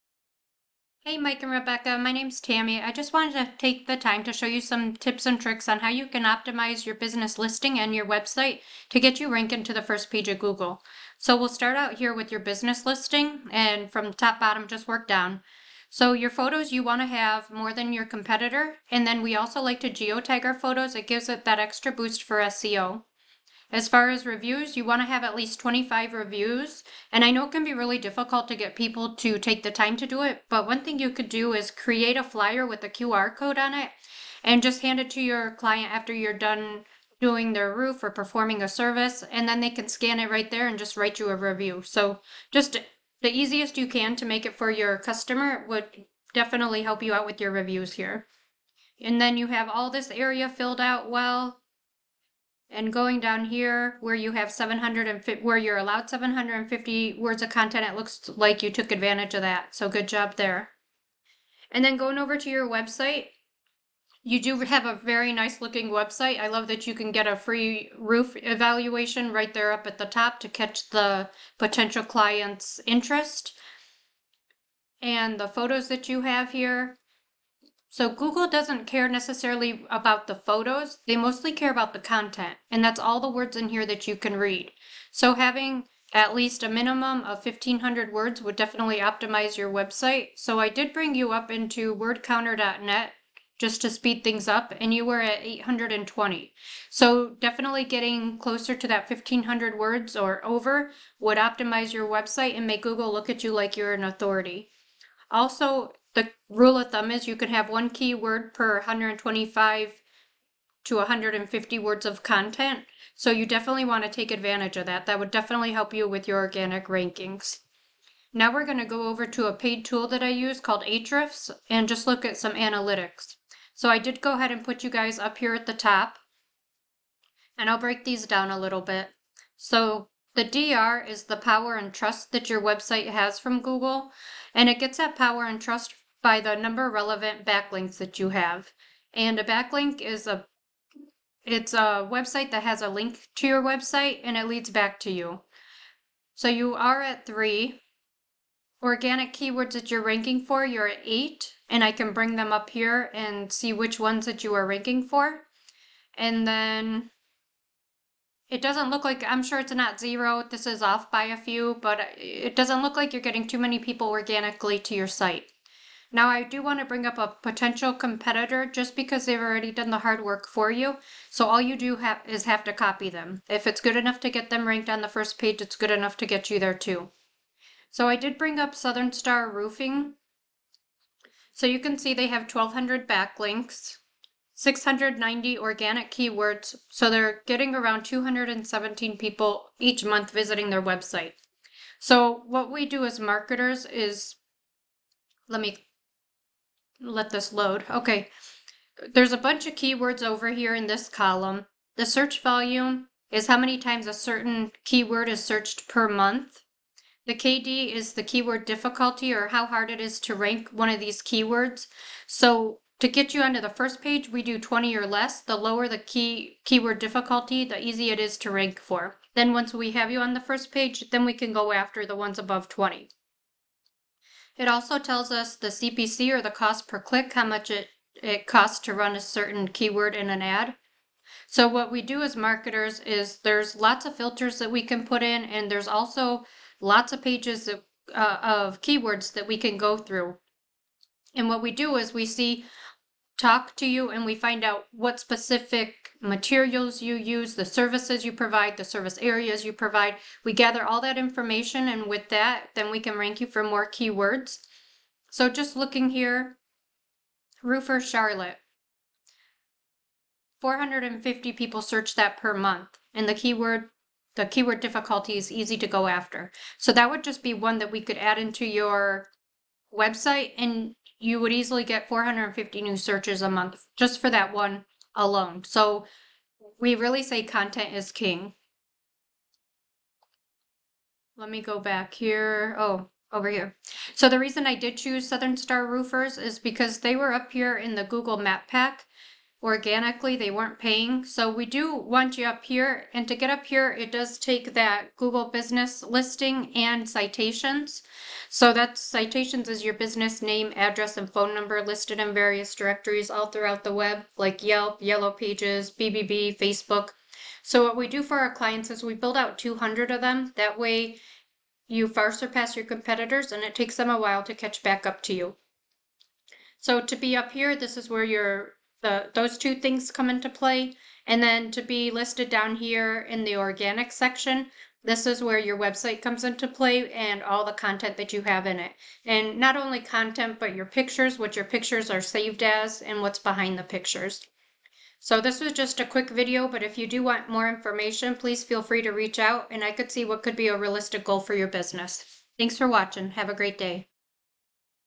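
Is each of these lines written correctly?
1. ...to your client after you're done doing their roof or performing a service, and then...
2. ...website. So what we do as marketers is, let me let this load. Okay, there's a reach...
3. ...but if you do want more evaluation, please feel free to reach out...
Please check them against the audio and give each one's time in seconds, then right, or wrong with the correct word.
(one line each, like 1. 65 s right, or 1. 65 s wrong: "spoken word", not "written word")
1. 35 s right
2. 190 s wrong: "bunch", not "reach"
3. 336 s wrong: "information", not "evaluation".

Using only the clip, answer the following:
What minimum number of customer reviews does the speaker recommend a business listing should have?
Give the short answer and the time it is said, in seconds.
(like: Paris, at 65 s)
25, at 25 s.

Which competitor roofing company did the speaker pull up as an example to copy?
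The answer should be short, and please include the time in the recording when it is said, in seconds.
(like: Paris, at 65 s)
Southern Star Roofing, at 178 s.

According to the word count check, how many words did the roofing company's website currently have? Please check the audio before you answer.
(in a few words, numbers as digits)
820.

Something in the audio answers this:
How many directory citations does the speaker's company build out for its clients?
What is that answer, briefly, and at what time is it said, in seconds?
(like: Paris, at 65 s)
200, at 309 s.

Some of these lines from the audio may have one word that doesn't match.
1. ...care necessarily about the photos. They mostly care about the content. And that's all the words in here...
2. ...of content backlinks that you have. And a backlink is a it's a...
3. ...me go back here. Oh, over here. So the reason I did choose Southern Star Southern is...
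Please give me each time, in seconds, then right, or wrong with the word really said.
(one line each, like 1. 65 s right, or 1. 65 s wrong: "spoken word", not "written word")
1. 78 s right
2. 136 s wrong: "relevant", not "content"
3. 281 s wrong: "Roofers", not "Southern".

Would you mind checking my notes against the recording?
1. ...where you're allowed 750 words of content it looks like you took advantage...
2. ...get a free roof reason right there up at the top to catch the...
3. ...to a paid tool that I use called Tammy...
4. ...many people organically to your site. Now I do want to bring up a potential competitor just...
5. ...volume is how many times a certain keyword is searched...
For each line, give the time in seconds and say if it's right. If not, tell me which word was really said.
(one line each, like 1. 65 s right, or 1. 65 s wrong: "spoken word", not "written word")
1. 55 s right
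2. 67 s wrong: "evaluation", not "reason"
3. 119 s wrong: "Ahrefs", not "Tammy"
4. 163 s right
5. 202 s right.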